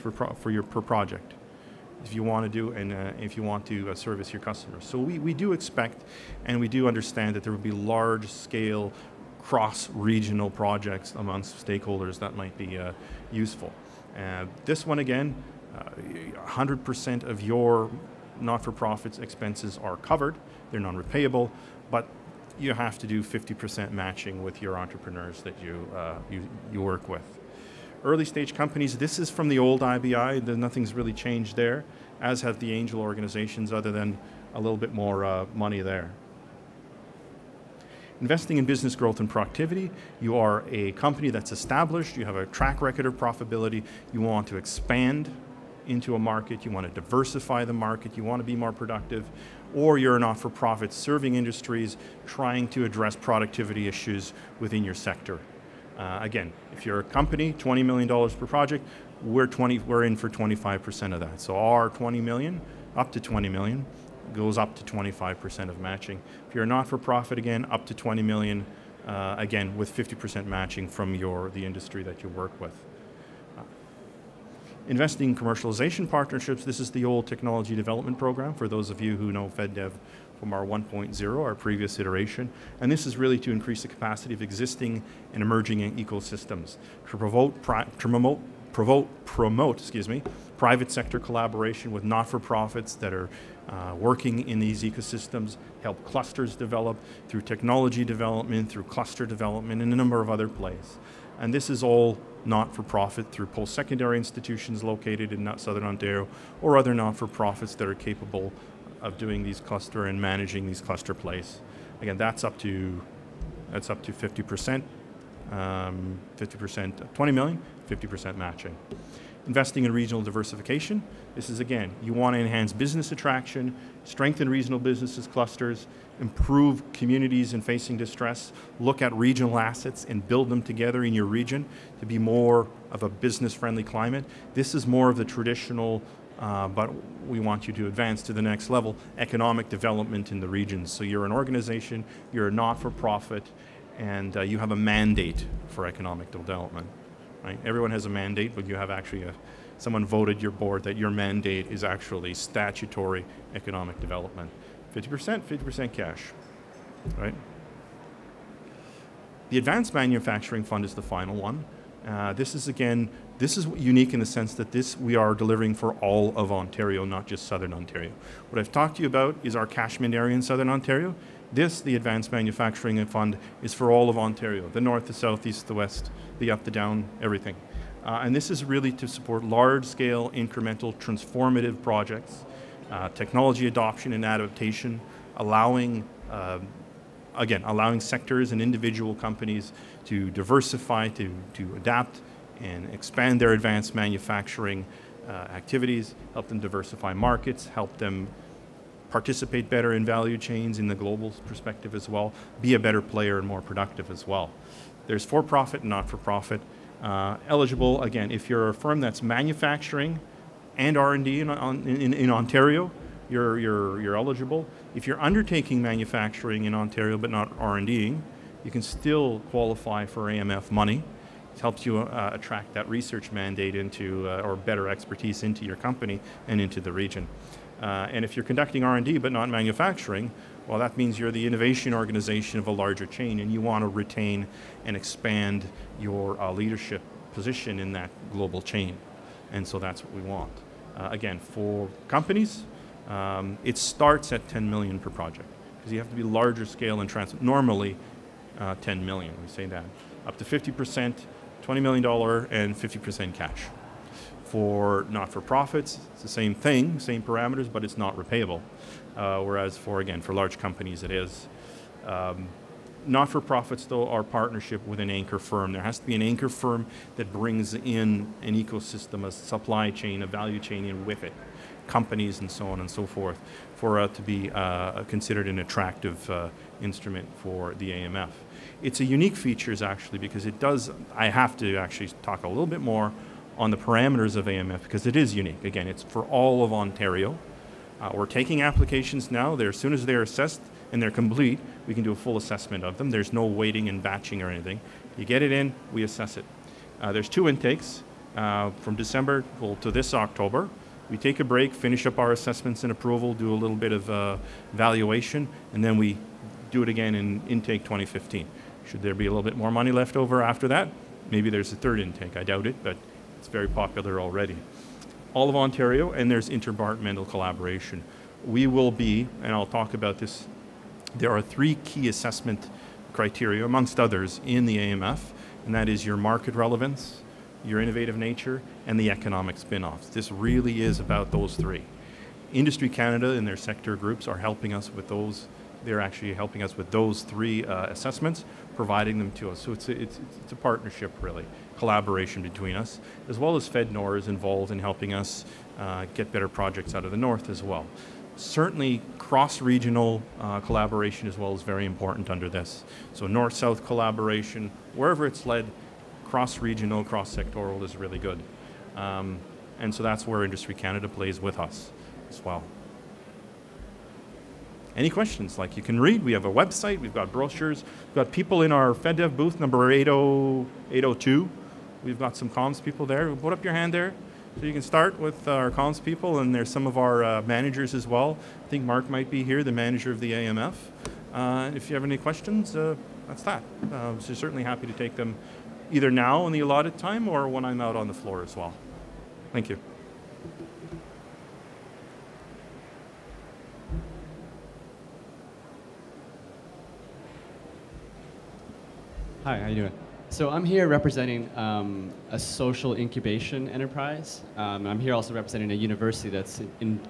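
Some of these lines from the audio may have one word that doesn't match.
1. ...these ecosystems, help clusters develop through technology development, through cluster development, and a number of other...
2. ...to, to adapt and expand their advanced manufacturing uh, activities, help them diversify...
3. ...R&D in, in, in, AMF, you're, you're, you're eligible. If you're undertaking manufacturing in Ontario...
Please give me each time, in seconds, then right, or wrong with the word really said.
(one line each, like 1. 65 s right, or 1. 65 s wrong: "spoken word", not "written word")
1. 94 s right
2. 191 s right
3. 210 s wrong: "Ontario", not "AMF".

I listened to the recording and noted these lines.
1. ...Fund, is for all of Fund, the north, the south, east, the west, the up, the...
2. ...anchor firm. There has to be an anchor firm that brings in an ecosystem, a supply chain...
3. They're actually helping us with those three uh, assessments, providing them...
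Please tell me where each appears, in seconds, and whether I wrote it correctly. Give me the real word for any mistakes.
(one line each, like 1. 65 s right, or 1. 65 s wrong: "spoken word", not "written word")
1. 173 s wrong: "Ontario", not "Fund"
2. 265 s right
3. 335 s right.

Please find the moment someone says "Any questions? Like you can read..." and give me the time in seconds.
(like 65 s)
364 s.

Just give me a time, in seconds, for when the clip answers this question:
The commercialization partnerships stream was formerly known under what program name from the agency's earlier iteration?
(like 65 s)
77 s.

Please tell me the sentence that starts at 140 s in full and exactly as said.
So you're an organization, you're a not for profit, and uh, you have a mandate for economic development.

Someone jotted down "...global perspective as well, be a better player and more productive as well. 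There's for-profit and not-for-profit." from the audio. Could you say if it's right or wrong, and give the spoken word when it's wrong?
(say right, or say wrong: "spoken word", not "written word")
right.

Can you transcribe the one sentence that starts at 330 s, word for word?
This really is about those three.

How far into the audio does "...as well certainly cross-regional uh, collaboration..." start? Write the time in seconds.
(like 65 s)
347 s.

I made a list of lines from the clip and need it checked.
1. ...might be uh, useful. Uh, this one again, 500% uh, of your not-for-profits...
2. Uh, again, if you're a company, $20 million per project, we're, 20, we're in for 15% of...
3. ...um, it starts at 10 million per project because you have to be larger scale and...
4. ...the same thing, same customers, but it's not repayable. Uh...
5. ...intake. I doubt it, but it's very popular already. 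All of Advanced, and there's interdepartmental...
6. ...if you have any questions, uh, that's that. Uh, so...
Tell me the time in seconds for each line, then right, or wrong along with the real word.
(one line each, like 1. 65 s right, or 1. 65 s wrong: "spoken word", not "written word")
1. 12 s wrong: "100", not "500"
2. 55 s wrong: "25", not "15"
3. 243 s right
4. 256 s wrong: "parameters", not "customers"
5. 312 s wrong: "Ontario", not "Advanced"
6. 381 s right.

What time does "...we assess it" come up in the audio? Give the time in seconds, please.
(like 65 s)
295 s.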